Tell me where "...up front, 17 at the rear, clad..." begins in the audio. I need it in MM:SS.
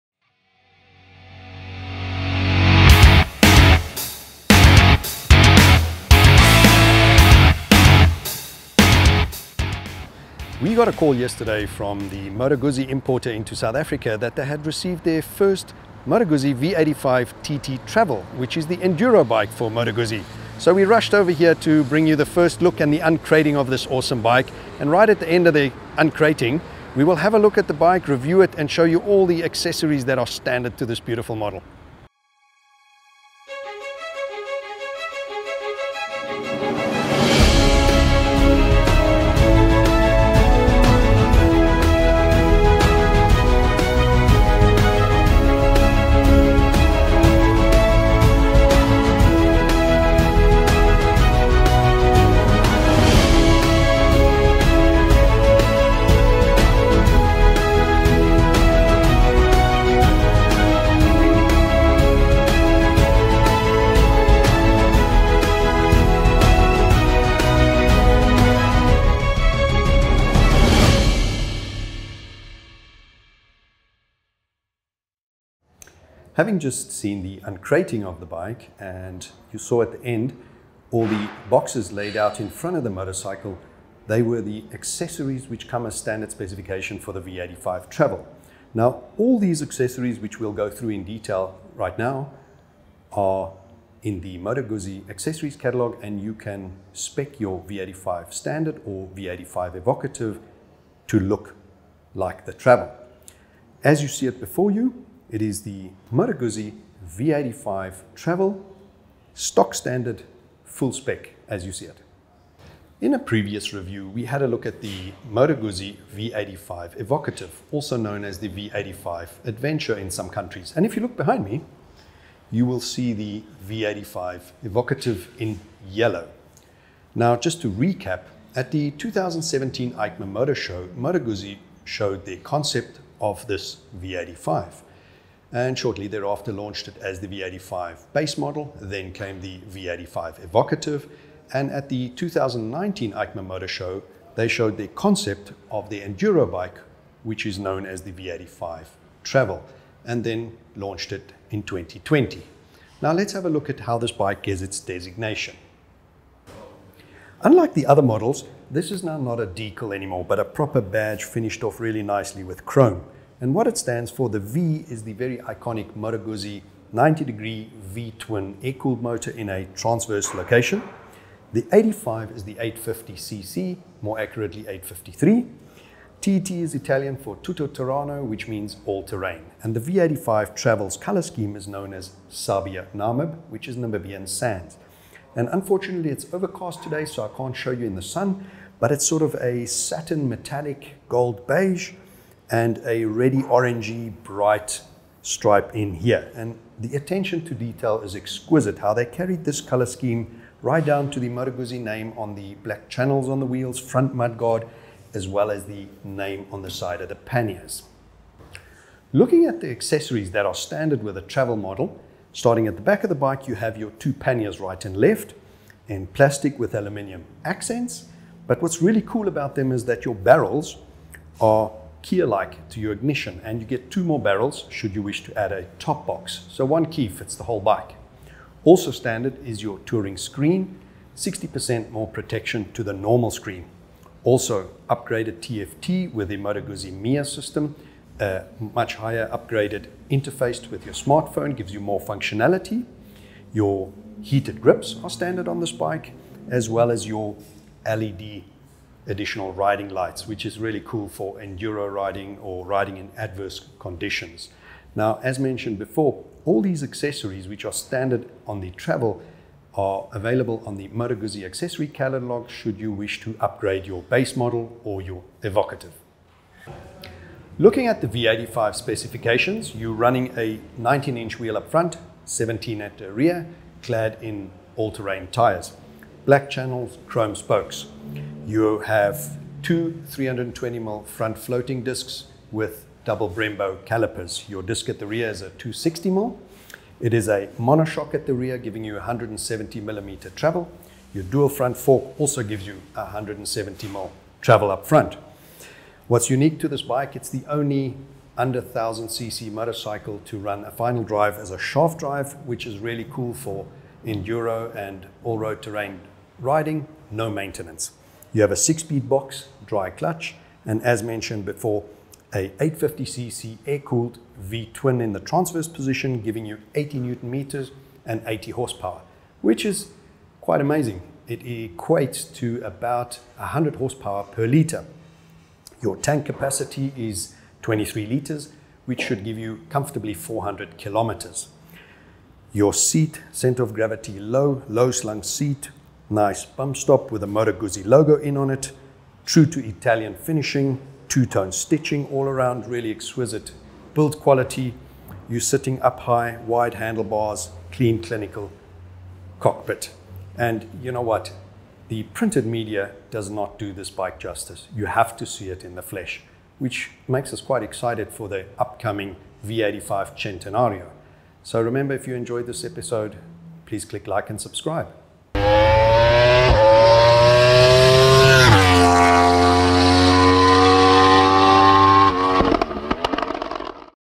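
04:31.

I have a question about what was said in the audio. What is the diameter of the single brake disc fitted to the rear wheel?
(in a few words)
260 mm.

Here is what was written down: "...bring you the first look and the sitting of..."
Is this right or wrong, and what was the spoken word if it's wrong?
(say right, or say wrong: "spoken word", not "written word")
wrong: "uncrating", not "sitting".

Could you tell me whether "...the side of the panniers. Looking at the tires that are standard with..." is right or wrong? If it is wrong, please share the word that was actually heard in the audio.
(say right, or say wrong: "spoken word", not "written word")
wrong: "accessories", not "tires".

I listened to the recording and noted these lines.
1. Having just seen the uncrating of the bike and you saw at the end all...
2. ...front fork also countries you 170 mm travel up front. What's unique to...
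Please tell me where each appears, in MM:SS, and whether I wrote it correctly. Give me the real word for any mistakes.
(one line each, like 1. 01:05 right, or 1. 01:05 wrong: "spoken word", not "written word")
1. 01:16 right
2. 04:51 wrong: "gives", not "countries".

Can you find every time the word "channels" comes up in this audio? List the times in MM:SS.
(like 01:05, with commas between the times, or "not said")
03:22, 04:36.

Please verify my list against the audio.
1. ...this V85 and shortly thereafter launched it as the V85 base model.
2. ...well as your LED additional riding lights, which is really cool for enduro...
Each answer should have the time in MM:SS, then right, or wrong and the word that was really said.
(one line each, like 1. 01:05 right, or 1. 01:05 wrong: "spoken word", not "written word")
1. 02:13 right
2. 04:06 right.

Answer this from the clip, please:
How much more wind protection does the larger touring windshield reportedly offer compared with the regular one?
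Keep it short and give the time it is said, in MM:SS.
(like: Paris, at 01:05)
60%, at 03:51.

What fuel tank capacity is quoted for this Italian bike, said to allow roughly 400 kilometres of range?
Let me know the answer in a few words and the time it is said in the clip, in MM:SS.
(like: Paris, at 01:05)
23 liters, at 05:27.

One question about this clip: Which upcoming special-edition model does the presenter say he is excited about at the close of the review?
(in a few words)
V85 Centenario.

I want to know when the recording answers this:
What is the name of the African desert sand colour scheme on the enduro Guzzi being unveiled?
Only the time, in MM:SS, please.
03:02.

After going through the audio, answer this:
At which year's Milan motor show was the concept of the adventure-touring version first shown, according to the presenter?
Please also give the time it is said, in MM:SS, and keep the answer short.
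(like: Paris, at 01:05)
2019, at 02:22.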